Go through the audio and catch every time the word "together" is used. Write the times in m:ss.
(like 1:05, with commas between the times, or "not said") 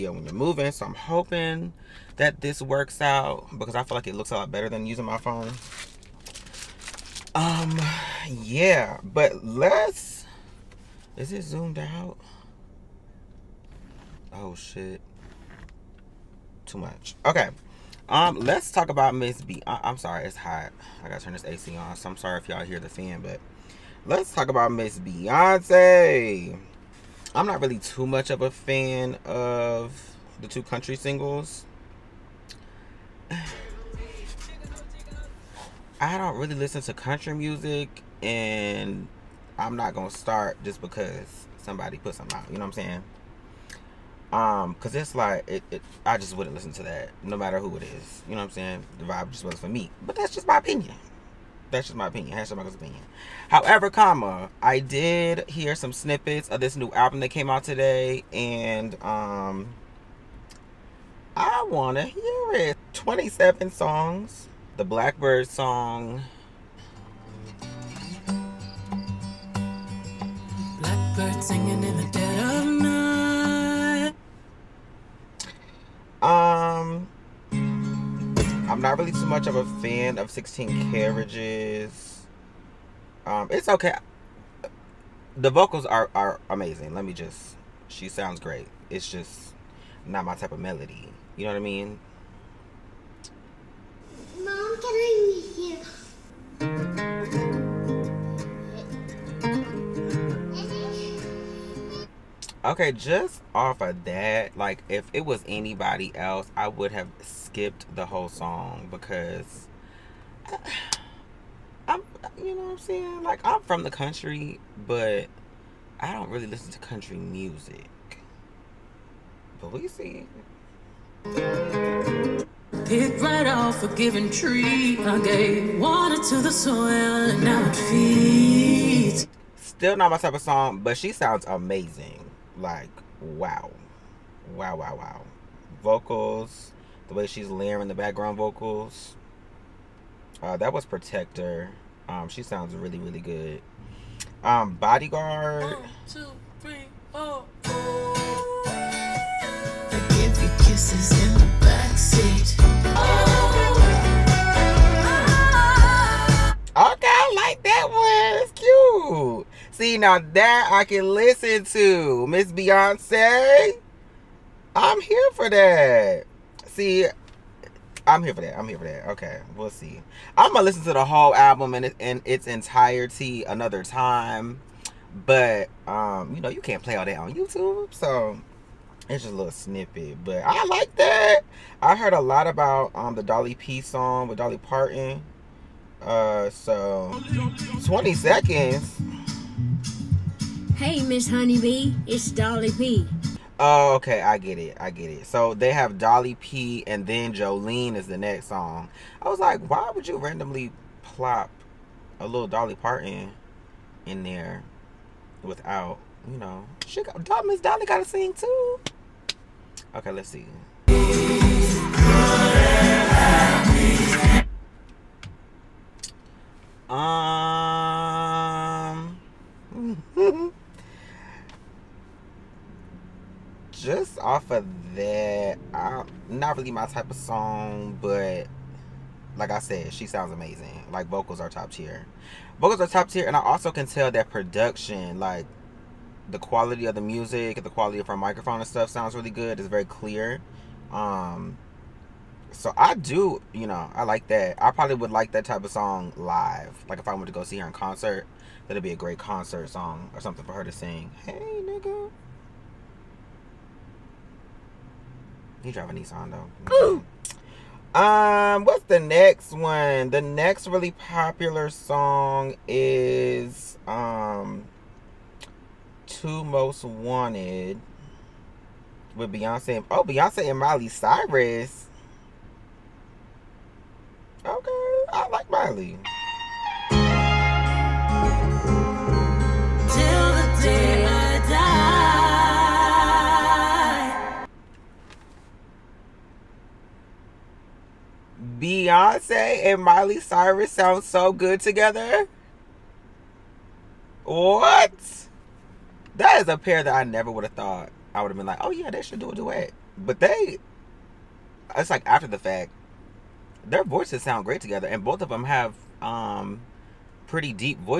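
4:51, 5:04.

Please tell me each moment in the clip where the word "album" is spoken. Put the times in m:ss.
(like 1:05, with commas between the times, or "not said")
0:56, 2:51.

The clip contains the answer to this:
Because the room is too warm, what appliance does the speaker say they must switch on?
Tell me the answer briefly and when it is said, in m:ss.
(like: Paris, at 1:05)
AC, at 0:21.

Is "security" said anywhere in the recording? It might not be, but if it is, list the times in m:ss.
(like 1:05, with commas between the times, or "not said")
not said.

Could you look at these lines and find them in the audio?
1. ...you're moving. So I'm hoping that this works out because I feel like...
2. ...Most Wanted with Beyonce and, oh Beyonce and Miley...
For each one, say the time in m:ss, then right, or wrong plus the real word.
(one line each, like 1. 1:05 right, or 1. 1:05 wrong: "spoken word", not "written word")
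1. 0:00 right
2. 4:26 right.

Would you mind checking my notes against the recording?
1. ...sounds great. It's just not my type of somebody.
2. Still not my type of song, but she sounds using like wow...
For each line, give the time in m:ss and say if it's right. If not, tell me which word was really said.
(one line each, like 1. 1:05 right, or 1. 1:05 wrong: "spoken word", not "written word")
1. 1:28 wrong: "melody", not "somebody"
2. 2:09 wrong: "amazing", not "using".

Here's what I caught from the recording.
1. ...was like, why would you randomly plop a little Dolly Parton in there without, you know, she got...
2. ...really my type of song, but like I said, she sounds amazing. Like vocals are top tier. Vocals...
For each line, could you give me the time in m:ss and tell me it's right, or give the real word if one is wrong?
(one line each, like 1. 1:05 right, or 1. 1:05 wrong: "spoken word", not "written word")
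1. 3:19 right
2. 3:46 right.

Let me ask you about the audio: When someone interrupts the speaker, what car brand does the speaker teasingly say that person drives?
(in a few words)
Nissan.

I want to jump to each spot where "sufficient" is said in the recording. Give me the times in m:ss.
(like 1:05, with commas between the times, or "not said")
not said.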